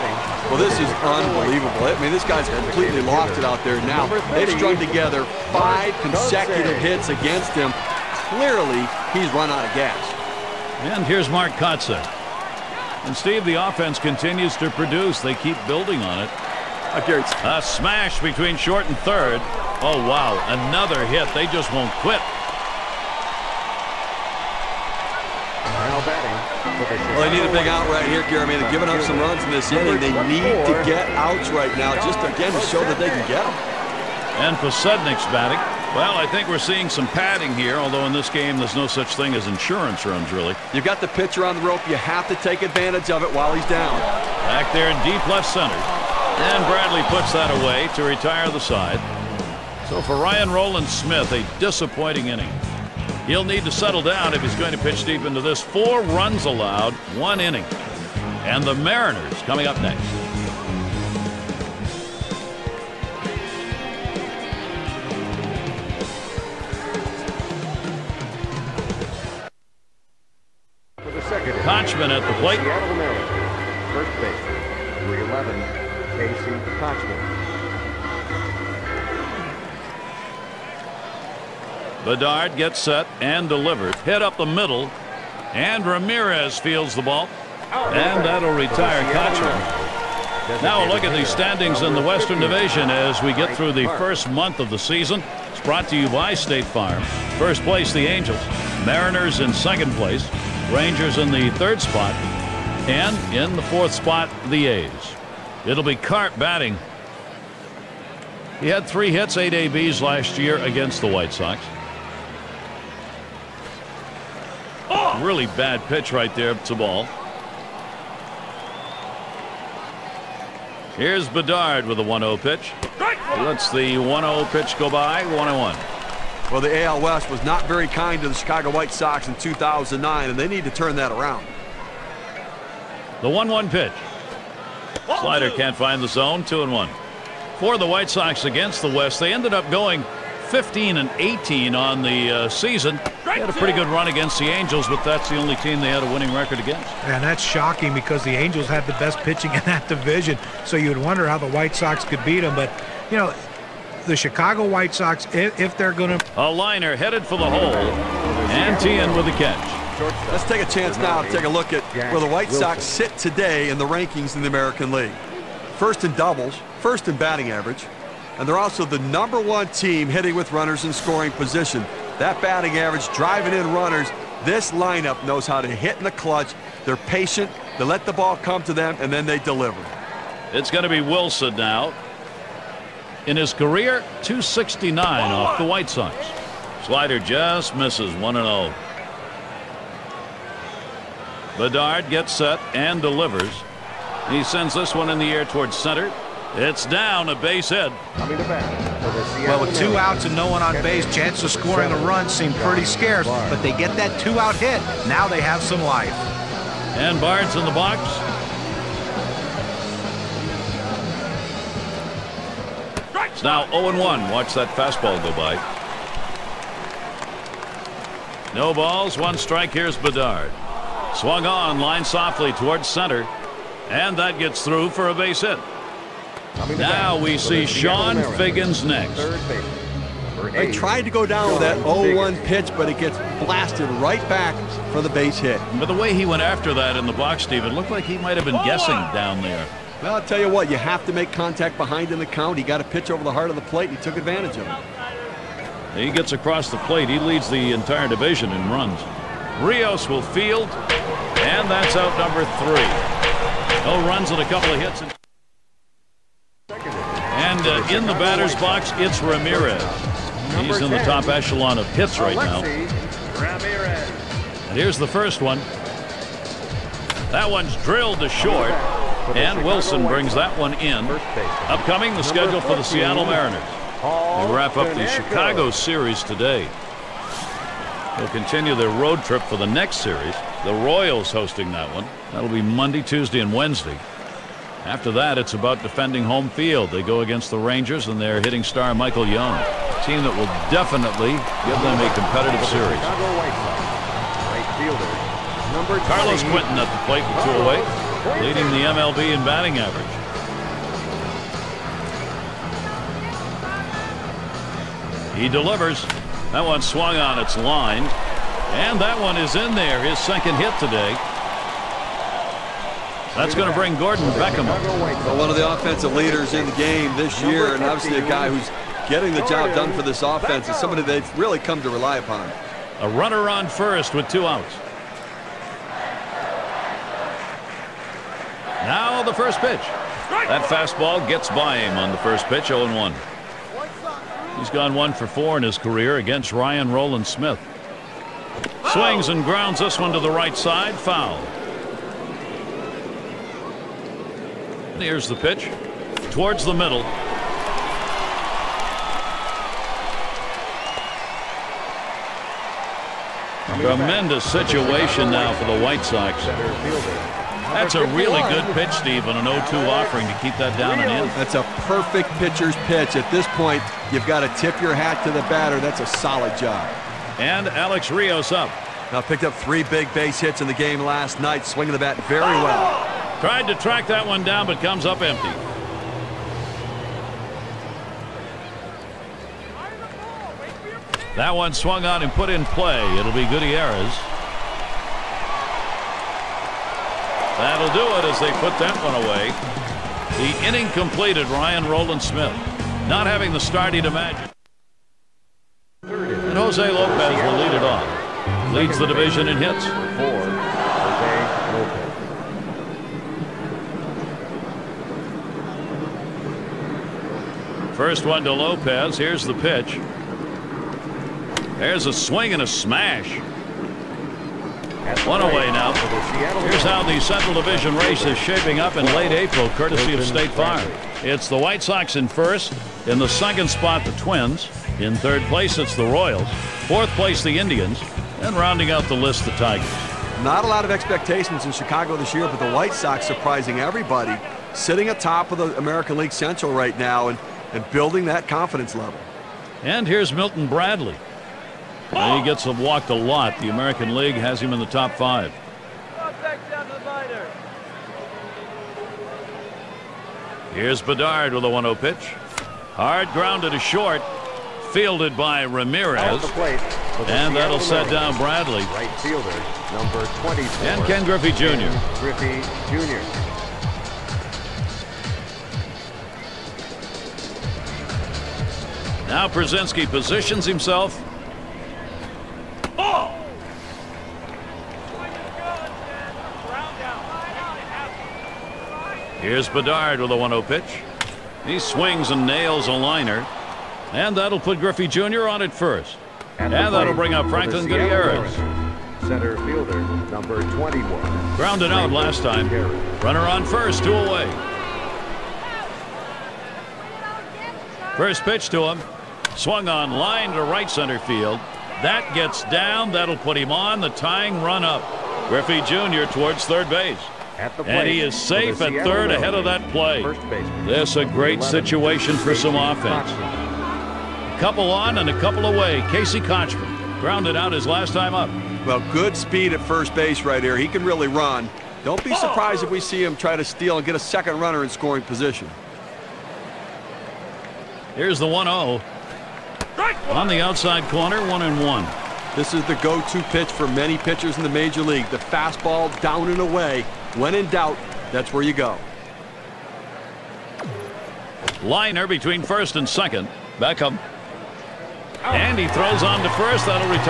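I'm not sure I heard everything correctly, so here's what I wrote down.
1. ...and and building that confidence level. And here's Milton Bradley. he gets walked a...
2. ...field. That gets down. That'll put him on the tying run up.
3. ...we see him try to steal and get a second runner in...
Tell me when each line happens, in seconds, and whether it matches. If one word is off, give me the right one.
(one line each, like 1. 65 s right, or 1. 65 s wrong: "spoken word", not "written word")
1. 437 s right
2. 501 s right
3. 522 s right.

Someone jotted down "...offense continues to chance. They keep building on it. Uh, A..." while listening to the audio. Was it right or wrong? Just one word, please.
wrong.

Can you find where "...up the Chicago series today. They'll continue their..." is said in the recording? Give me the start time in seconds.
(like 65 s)
274 s.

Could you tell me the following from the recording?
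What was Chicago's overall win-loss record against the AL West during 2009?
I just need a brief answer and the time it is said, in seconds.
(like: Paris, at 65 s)
15 and 18, at 140 s.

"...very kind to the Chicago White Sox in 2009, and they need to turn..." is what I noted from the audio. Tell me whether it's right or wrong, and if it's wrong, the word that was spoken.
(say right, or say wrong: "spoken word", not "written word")
right.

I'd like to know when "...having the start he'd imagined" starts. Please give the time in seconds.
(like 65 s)
393 s.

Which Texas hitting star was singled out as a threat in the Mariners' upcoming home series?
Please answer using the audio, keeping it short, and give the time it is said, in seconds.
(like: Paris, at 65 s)
Michael Young, at 288 s.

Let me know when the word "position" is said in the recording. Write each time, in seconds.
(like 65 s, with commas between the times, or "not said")
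171 s, 470 s, 525 s.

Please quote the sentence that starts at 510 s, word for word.
This a great situation for some offense.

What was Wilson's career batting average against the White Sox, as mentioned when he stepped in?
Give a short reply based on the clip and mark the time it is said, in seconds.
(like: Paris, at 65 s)
269, at 184 s.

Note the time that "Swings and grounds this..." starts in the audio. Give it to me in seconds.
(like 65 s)
338 s.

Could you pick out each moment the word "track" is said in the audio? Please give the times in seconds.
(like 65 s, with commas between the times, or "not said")
373 s.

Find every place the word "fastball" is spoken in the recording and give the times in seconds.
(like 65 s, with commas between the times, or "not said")
214 s, 330 s, 535 s.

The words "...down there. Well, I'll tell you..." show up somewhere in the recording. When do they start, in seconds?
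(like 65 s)
239 s.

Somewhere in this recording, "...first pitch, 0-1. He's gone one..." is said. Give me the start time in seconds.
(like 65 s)
332 s.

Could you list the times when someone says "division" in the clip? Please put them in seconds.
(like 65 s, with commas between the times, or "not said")
92 s, 149 s, 248 s, 399 s, 417 s.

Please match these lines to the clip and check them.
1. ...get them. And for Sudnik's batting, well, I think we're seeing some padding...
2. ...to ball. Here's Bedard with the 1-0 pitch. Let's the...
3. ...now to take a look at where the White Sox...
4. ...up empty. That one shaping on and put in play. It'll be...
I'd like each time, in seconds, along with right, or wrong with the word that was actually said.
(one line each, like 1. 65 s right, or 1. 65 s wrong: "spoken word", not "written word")
1. 33 s right
2. 116 s right
3. 160 s right
4. 375 s wrong: "swung", not "shaping".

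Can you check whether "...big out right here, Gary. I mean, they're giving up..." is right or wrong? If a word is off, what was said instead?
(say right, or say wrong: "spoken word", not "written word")
right.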